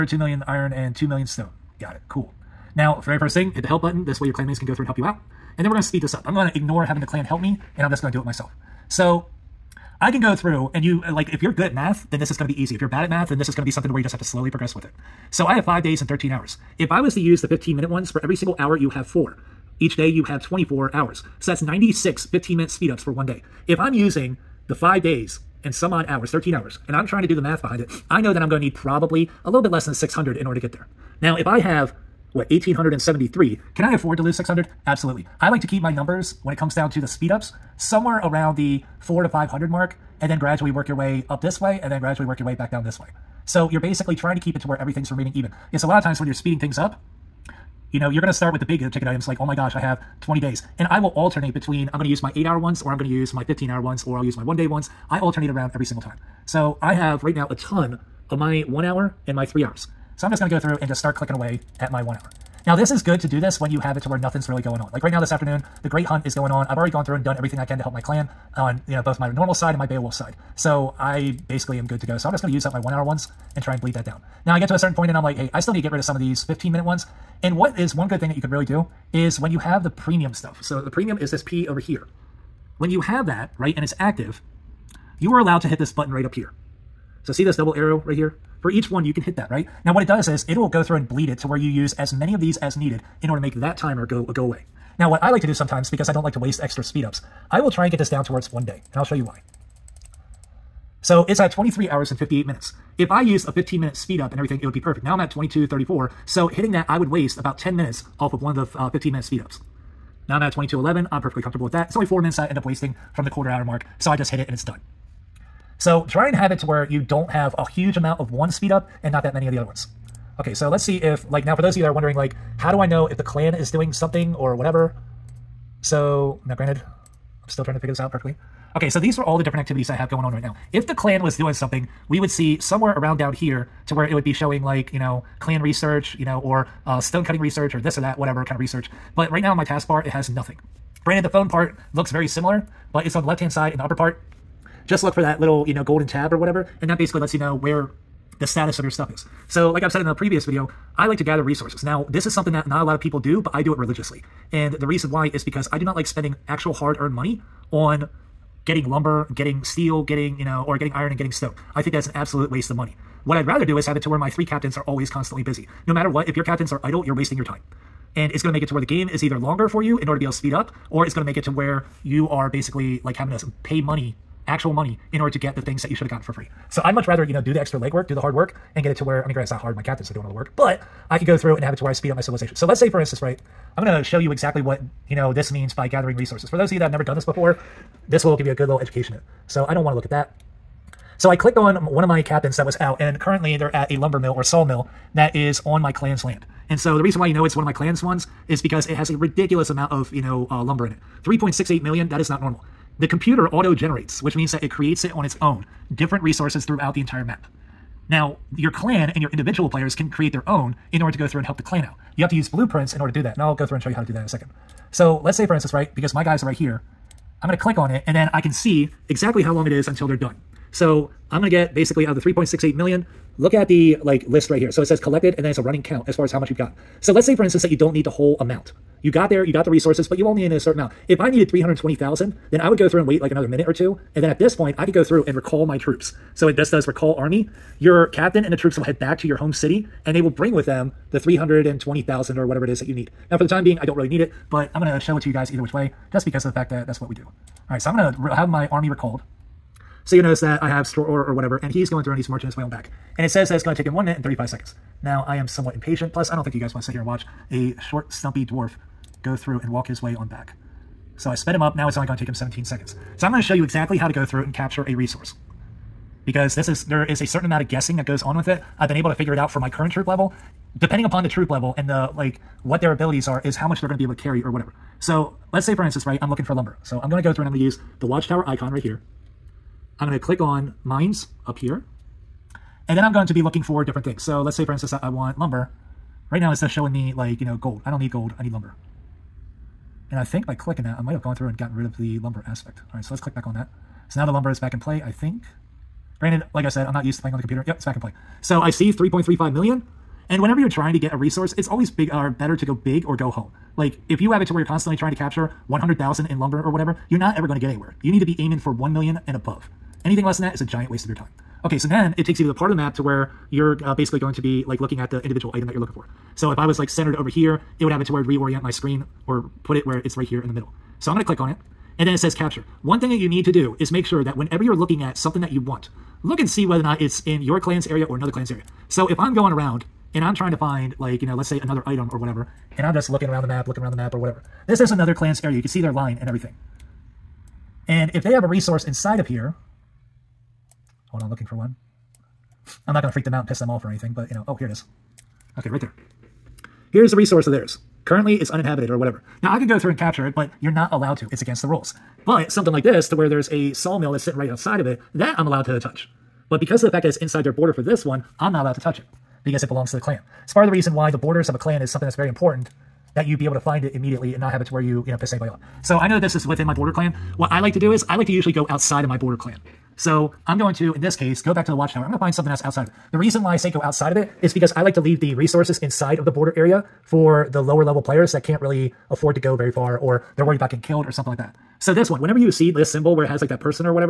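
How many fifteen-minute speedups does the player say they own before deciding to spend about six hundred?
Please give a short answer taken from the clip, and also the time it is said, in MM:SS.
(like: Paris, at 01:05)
1873, at 00:32.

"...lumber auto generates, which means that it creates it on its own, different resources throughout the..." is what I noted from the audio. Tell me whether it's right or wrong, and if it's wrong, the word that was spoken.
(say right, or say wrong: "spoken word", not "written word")
wrong: "computer", not "lumber".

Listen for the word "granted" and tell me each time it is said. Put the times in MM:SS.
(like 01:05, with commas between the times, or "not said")
02:06, 02:21, 02:59, 04:56.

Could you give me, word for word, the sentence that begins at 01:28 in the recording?
For each one, you can hit that, right?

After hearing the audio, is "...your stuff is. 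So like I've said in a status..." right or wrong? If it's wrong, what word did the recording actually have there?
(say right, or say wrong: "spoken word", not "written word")
wrong: "previous", not "status".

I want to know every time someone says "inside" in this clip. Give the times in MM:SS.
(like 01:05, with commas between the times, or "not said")
05:38, 05:57, 06:15.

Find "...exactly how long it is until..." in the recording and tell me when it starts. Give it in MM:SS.
03:39.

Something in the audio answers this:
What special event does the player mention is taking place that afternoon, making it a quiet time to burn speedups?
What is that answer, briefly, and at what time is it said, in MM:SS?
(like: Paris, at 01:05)
The Great Hunt, at 01:05.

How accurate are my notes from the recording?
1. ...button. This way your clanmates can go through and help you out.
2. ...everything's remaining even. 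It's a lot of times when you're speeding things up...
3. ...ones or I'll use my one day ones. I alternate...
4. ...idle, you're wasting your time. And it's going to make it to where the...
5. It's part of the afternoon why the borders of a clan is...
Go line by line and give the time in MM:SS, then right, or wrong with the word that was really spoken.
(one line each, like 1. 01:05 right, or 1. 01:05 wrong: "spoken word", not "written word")
1. 00:03 right
2. 00:44 right
3. 00:53 right
4. 02:46 right
5. 06:00 wrong: "reason", not "afternoon".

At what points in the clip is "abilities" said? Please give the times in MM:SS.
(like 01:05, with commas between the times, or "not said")
04:32.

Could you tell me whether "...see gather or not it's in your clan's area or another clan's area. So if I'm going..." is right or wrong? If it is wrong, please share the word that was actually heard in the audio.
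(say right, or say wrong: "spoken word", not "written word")
wrong: "whether", not "gather".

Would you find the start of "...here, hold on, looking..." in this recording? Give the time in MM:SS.
05:39.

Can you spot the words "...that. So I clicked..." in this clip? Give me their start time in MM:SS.
03:10.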